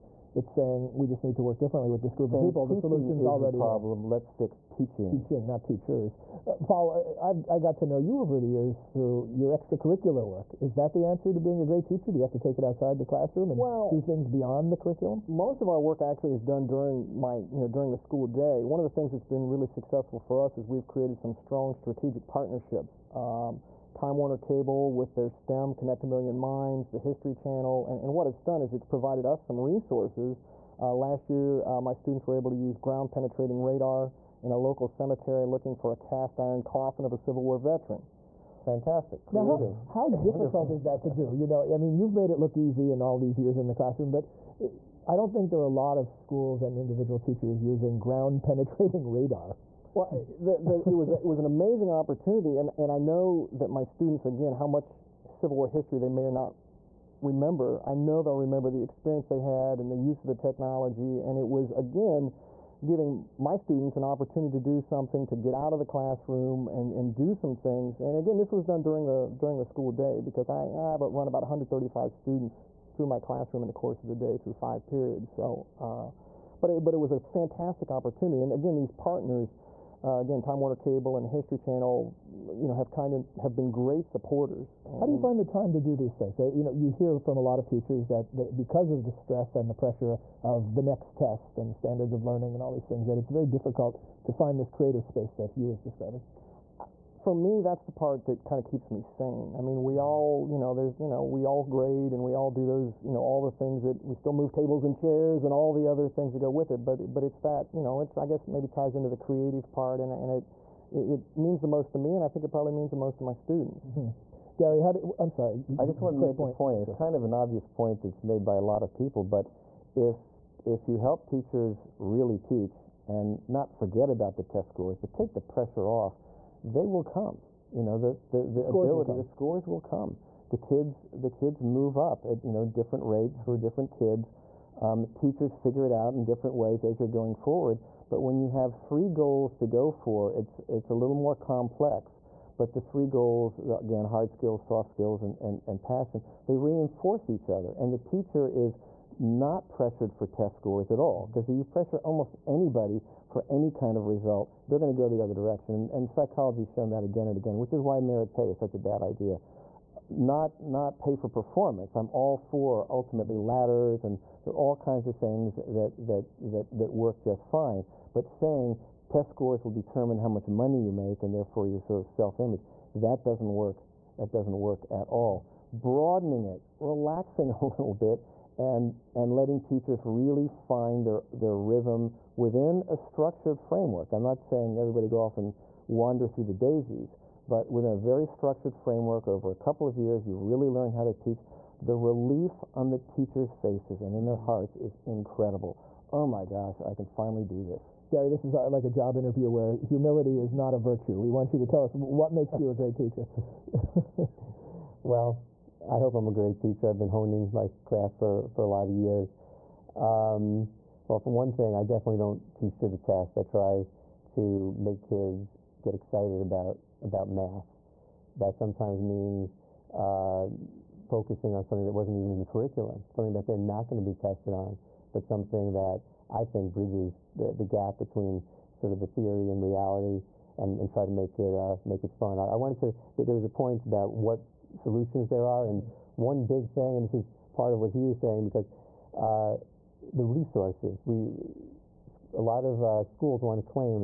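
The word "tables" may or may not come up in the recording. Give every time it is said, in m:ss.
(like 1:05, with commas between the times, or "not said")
1:44.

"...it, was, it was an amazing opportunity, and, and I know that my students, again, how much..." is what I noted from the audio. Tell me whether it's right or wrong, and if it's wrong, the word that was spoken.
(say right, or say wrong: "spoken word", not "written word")
right.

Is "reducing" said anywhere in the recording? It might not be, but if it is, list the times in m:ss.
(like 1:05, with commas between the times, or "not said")
not said.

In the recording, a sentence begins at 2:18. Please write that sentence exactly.
But when you have three goals to go for, it's it's a little more complex.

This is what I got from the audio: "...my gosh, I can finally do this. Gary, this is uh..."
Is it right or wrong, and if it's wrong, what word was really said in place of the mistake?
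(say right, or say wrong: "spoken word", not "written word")
right.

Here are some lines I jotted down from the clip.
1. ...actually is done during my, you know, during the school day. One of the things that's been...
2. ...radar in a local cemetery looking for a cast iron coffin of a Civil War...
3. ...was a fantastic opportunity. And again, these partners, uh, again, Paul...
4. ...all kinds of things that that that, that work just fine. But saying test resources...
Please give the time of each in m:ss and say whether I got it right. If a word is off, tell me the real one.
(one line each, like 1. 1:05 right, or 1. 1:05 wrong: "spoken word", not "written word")
1. 0:16 right
2. 0:33 right
3. 1:16 wrong: "Time", not "Paul"
4. 2:44 wrong: "scores", not "resources".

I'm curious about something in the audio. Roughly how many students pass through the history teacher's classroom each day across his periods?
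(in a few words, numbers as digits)
135.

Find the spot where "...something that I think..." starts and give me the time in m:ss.
3:45.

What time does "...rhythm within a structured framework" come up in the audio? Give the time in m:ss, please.
3:01.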